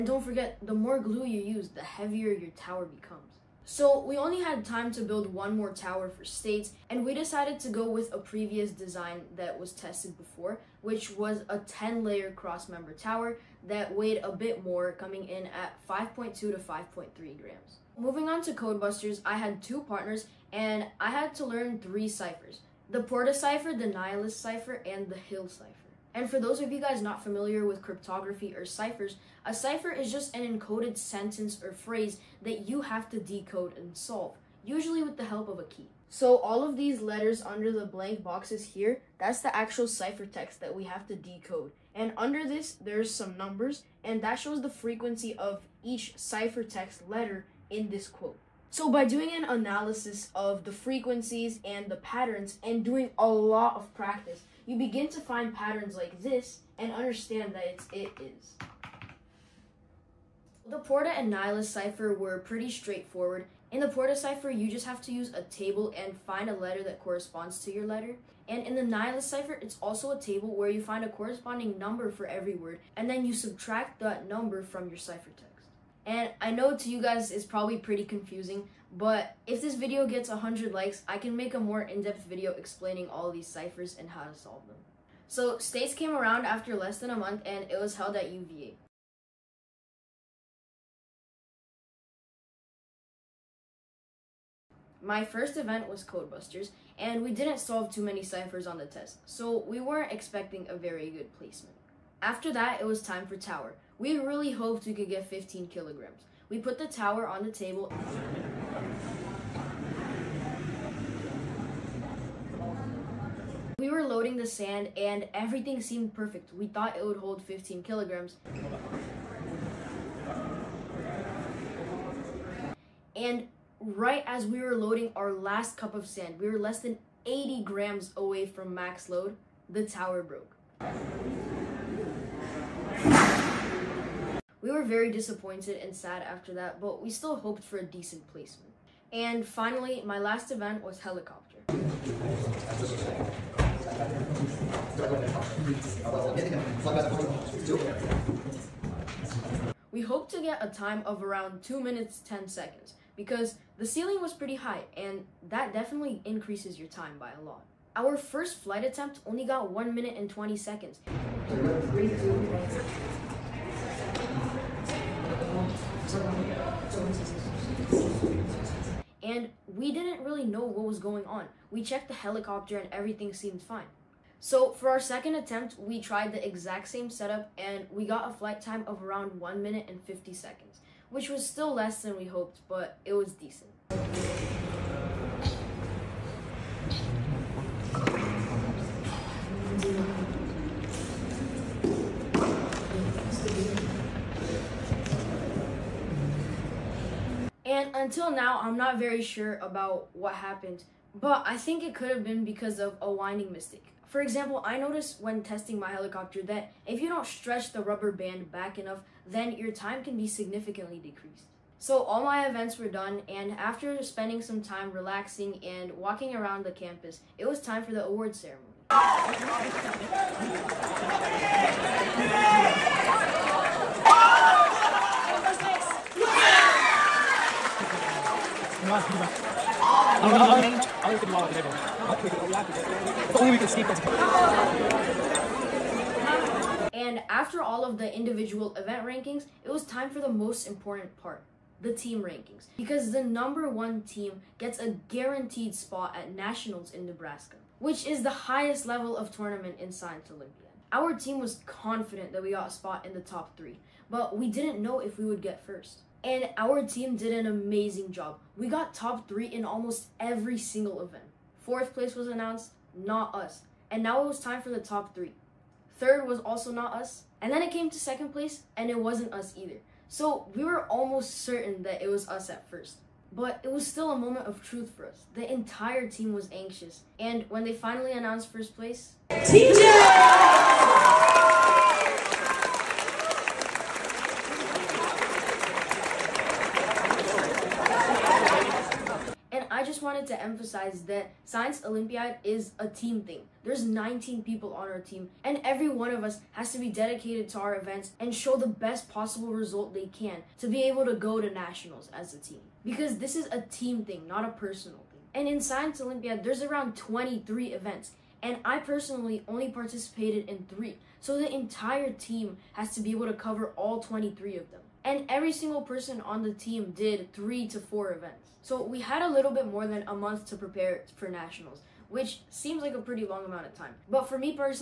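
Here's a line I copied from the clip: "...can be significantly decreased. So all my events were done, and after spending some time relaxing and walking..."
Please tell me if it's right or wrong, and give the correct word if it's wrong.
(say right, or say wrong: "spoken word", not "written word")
right.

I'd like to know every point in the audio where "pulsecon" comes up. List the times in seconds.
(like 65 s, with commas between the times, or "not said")
not said.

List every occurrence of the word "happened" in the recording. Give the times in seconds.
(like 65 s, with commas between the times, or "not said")
200 s.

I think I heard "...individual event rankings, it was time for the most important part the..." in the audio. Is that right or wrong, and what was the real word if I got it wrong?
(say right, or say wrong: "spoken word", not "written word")
right.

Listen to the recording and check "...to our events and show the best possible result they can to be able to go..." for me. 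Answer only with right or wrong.
right.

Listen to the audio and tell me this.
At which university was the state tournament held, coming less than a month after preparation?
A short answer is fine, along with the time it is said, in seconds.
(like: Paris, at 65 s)
UVA, at 88 s.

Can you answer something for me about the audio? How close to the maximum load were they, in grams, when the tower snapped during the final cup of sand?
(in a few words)
80 grams.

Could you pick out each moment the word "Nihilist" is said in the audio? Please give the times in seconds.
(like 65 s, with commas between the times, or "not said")
23 s, 61 s, 68 s.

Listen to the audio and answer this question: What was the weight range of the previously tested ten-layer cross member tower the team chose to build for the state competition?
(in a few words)
5.2 to 5.3 grams.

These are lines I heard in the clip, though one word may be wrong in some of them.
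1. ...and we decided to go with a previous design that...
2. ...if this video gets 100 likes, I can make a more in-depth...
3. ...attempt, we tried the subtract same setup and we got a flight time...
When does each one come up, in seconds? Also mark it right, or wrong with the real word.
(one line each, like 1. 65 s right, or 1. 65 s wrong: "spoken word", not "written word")
1. 6 s right
2. 79 s right
3. 175 s wrong: "exact", not "subtract".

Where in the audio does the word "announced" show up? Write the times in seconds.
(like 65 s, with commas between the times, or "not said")
262 s, 278 s.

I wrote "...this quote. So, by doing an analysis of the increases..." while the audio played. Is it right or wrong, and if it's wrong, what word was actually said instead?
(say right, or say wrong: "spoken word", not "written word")
wrong: "frequencies", not "increases".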